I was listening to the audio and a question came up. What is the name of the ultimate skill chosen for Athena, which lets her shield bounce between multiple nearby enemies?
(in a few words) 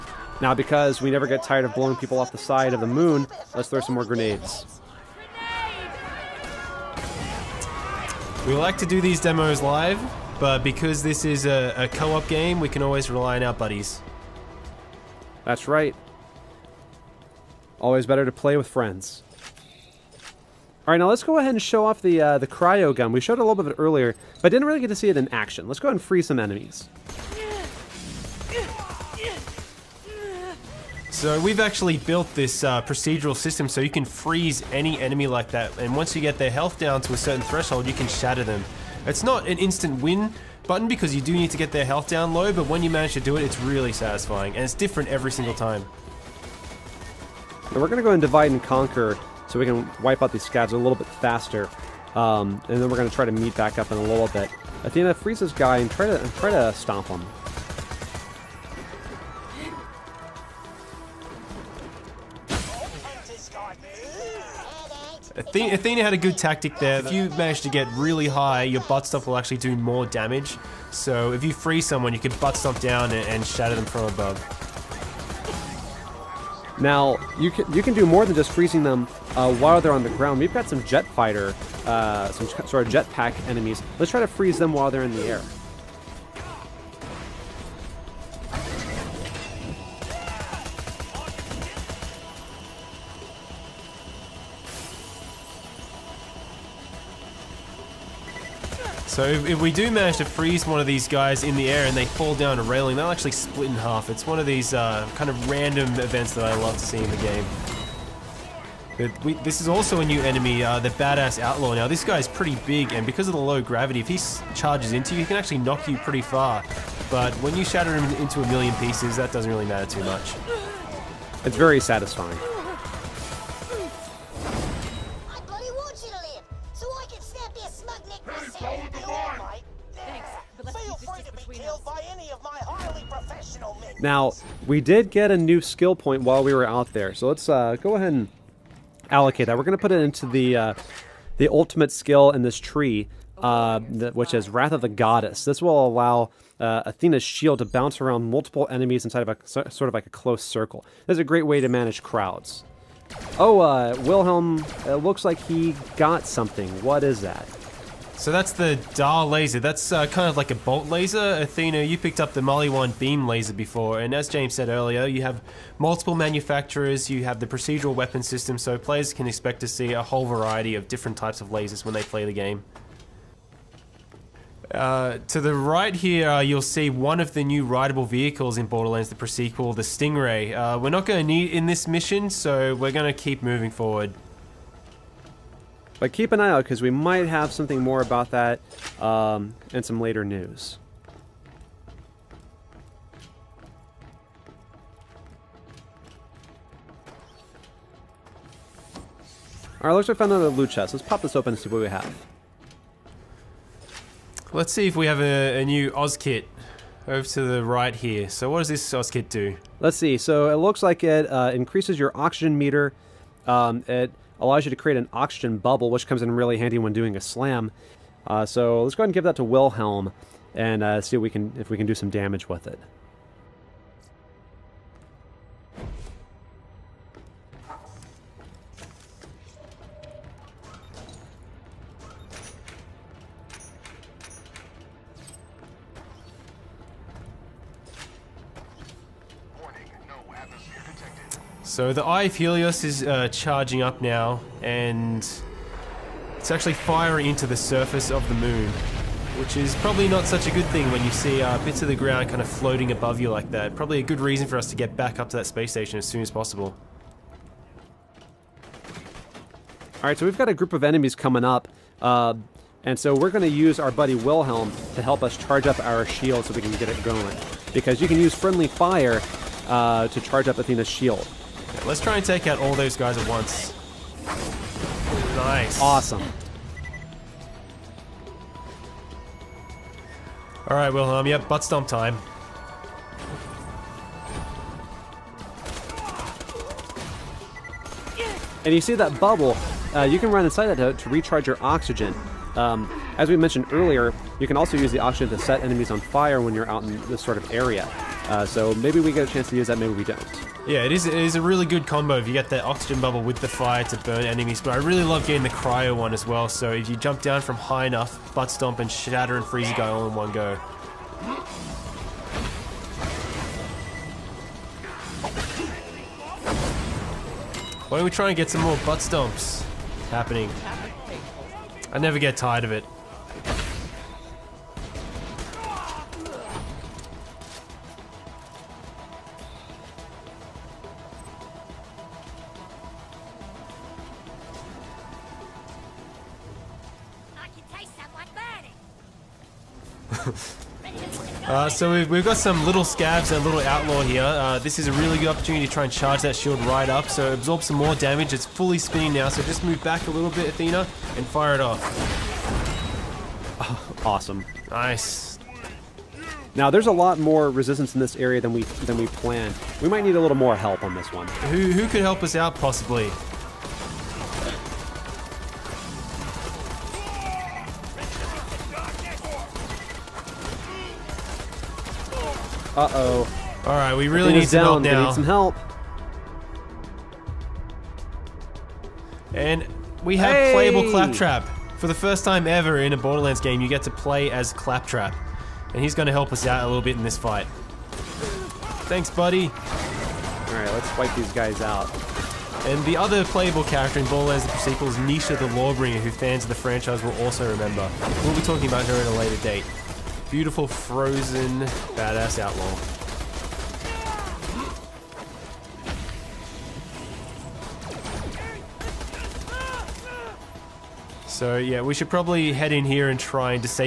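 Wrath of the Goddess.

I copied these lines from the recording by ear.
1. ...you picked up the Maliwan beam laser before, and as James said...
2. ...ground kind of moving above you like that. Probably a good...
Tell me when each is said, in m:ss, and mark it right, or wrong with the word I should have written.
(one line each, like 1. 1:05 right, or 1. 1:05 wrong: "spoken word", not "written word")
1. 2:41 right
2. 4:11 wrong: "floating", not "moving".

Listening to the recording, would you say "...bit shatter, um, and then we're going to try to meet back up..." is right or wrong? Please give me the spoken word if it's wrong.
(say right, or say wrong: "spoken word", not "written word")
wrong: "faster", not "shatter".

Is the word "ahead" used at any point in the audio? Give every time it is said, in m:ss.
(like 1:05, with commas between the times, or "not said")
0:21, 0:25, 2:17, 3:39.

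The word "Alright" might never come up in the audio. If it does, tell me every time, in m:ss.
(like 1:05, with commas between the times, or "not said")
3:19, 6:30.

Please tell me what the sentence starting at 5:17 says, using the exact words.
Why don't we try and get some more butt stomps happening?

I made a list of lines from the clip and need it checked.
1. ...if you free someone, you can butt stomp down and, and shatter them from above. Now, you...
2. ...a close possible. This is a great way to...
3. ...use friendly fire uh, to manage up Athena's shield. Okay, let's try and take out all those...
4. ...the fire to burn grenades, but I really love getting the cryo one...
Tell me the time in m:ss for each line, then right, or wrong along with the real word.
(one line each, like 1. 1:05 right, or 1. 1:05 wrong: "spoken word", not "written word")
1. 1:11 right
2. 2:30 wrong: "circle", not "possible"
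3. 4:28 wrong: "charge", not "manage"
4. 5:03 wrong: "enemies", not "grenades".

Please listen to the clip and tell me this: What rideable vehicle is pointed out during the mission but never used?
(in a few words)
Stingray.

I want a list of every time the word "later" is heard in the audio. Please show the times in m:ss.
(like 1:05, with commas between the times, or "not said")
3:10, 6:39.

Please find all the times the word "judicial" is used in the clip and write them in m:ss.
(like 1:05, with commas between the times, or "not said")
not said.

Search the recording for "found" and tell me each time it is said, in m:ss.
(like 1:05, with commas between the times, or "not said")
3:20.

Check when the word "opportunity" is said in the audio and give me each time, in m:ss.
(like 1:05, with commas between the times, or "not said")
5:45.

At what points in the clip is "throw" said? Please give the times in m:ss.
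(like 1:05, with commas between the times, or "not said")
0:03.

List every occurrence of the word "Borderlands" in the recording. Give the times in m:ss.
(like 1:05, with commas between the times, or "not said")
2:58, 6:22, 6:34.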